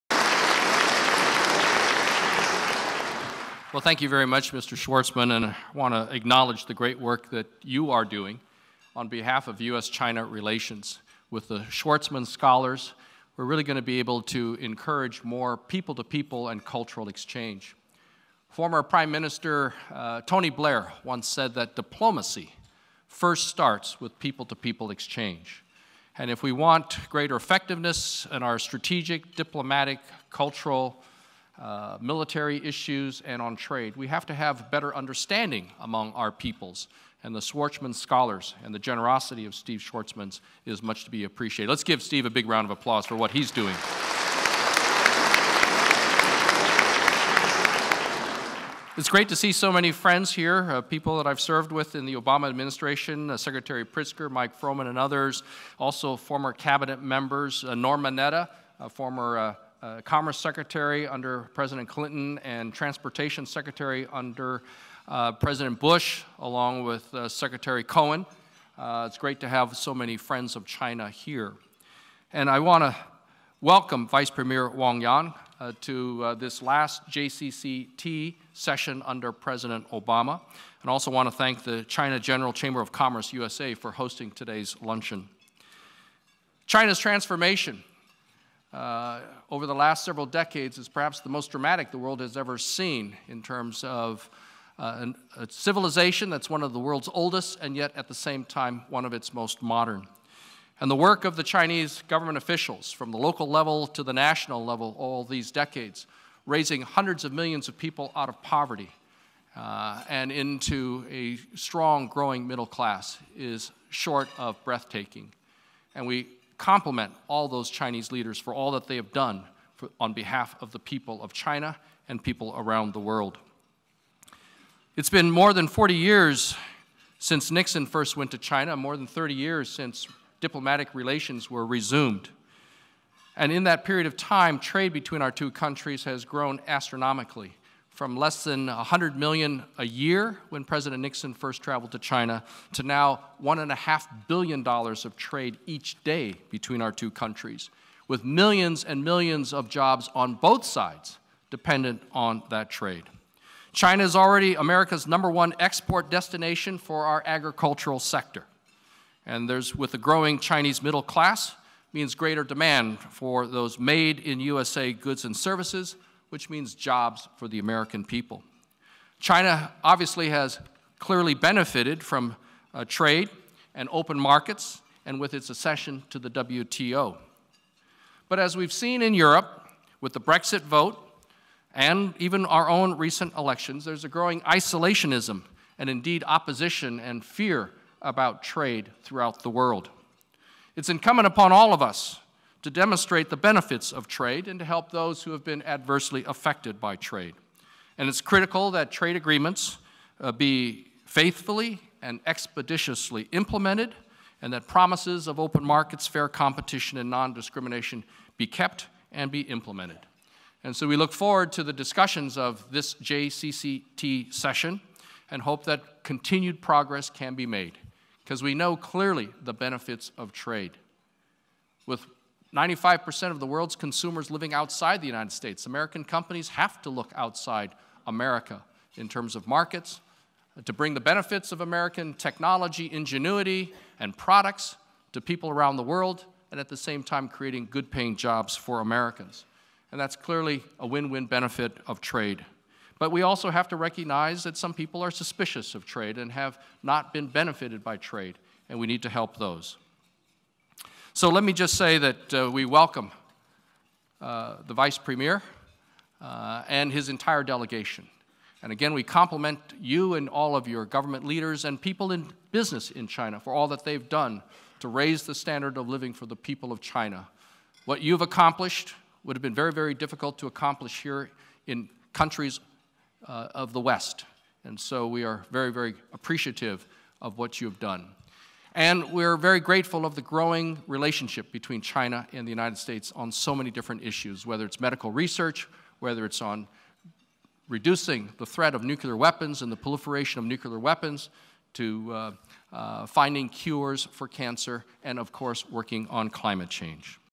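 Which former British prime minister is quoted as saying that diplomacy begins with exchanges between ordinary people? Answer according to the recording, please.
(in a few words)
Tony Blair.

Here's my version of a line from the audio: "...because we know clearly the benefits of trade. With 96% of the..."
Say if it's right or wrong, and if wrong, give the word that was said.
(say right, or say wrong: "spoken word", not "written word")
wrong: "95", not "96".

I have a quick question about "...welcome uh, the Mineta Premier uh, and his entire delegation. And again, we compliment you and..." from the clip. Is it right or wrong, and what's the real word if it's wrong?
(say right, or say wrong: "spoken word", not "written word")
wrong: "Vice", not "Mineta".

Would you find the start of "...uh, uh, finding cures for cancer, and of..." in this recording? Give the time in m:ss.
4:52.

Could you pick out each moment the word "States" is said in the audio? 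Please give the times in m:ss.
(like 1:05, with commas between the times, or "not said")
3:45, 4:42.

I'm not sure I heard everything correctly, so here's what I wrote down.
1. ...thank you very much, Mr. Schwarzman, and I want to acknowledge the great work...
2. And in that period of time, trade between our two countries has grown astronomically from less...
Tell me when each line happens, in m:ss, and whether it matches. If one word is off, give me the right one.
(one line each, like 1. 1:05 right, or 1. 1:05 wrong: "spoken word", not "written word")
1. 0:03 right
2. 2:13 right.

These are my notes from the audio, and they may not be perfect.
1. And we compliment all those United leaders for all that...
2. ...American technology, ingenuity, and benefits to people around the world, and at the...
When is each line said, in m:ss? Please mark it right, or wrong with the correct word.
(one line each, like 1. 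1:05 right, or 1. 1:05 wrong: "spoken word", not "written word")
1. 1:55 wrong: "Chinese", not "United"
2. 3:51 wrong: "products", not "benefits".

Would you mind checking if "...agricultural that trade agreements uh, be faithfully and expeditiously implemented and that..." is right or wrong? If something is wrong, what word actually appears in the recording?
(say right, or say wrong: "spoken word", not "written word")
wrong: "critical", not "agricultural".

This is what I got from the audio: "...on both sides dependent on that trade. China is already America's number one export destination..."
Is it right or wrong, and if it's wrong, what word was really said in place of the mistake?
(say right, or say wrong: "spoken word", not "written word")
right.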